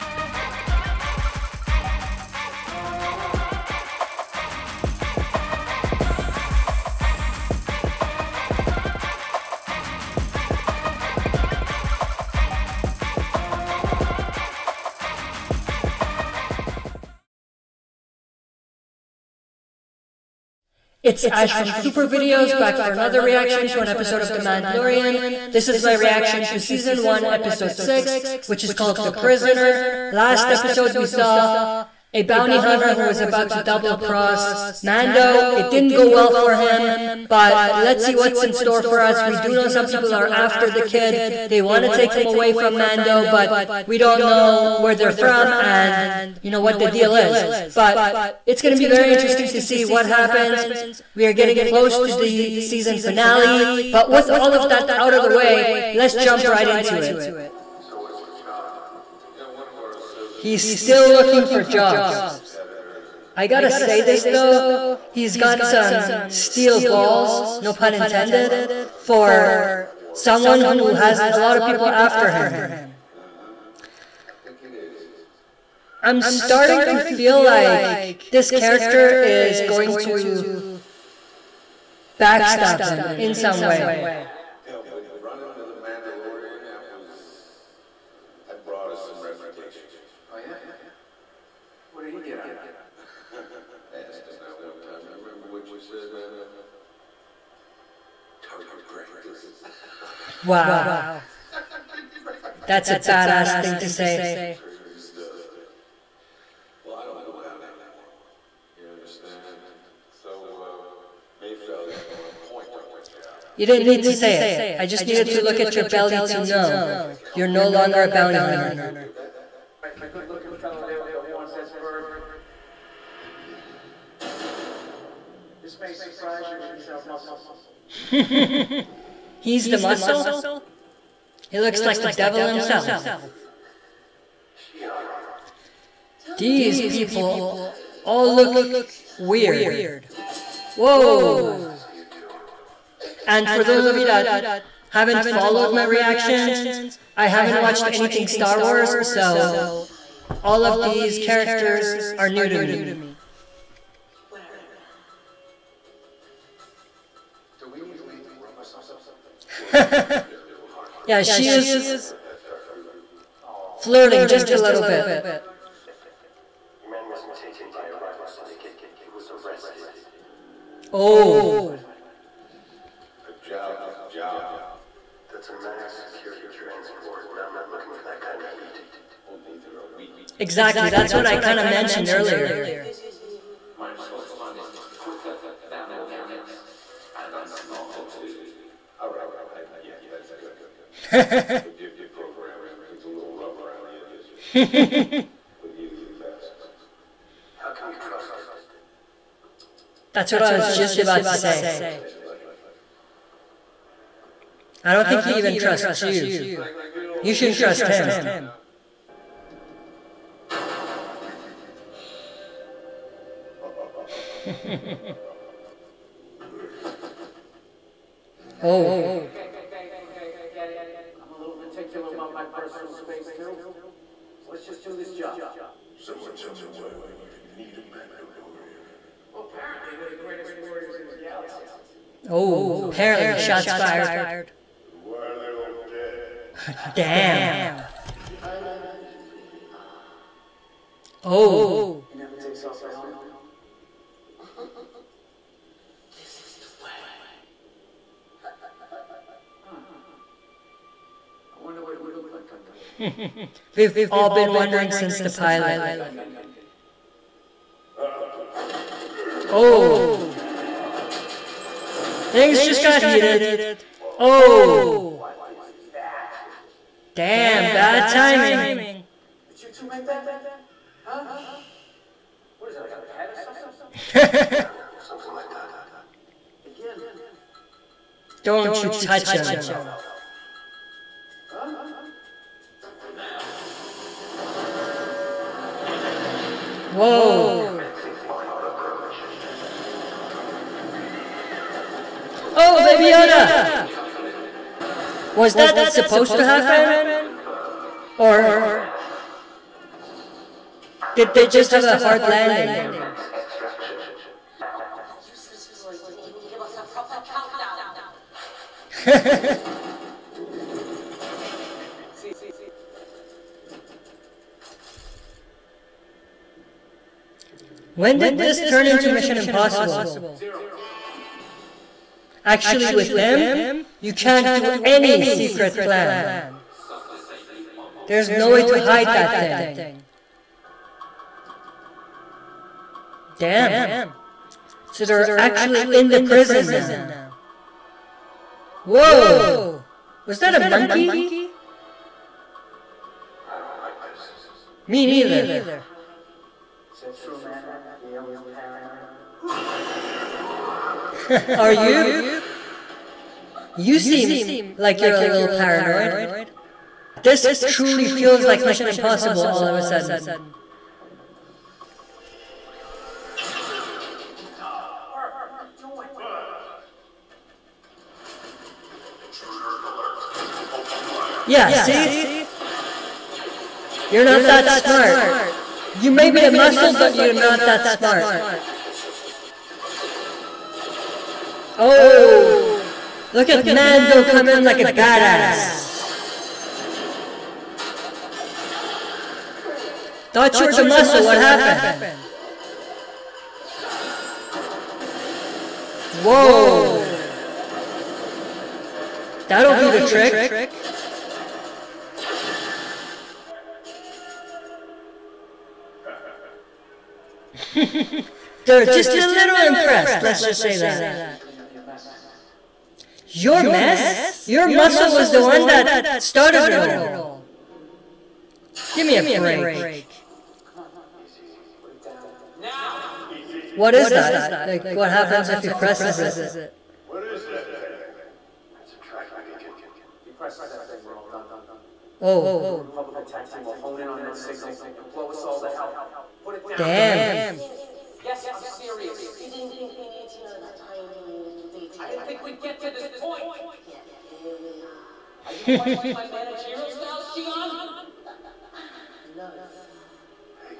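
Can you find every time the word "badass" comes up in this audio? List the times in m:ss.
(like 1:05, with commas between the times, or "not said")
1:42, 6:24.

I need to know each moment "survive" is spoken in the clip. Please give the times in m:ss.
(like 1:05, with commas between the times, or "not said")
not said.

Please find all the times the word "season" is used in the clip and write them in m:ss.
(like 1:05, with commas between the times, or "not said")
0:26, 0:52.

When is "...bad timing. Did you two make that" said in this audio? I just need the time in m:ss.
4:27.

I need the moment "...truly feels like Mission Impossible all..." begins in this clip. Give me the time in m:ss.
5:57.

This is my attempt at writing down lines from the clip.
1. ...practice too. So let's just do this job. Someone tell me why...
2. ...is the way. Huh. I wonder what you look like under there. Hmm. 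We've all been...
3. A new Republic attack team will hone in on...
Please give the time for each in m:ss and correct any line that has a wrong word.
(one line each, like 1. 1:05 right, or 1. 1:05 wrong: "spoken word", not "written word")
1. 3:42 wrong: "space", not "practice"
2. 4:06 right
3. 7:12 right.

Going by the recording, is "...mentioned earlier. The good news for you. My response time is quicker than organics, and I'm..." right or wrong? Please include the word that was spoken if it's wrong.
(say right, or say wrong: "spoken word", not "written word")
right.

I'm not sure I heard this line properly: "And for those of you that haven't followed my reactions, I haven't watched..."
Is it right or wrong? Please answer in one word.
right.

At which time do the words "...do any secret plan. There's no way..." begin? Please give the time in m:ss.
5:24.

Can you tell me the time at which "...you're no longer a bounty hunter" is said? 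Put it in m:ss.
1:57.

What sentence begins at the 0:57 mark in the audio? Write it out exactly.
So He's still looking for jobs.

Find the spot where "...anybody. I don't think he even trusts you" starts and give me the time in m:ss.
3:22.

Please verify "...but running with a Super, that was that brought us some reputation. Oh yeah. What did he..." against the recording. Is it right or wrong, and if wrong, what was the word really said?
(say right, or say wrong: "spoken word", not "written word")
wrong: "Mandalorian", not "Super".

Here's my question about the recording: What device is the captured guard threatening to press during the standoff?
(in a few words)
A tracking beacon.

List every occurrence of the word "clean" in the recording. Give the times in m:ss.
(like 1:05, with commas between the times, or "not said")
6:51.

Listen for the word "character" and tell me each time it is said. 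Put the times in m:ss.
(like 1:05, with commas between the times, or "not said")
1:18, 2:31.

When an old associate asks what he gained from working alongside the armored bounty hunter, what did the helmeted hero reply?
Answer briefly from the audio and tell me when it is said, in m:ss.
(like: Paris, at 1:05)
Target practice, at 1:38.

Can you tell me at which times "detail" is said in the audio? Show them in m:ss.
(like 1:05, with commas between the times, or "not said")
7:21.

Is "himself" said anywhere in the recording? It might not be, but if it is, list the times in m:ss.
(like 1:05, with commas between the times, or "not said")
2:12.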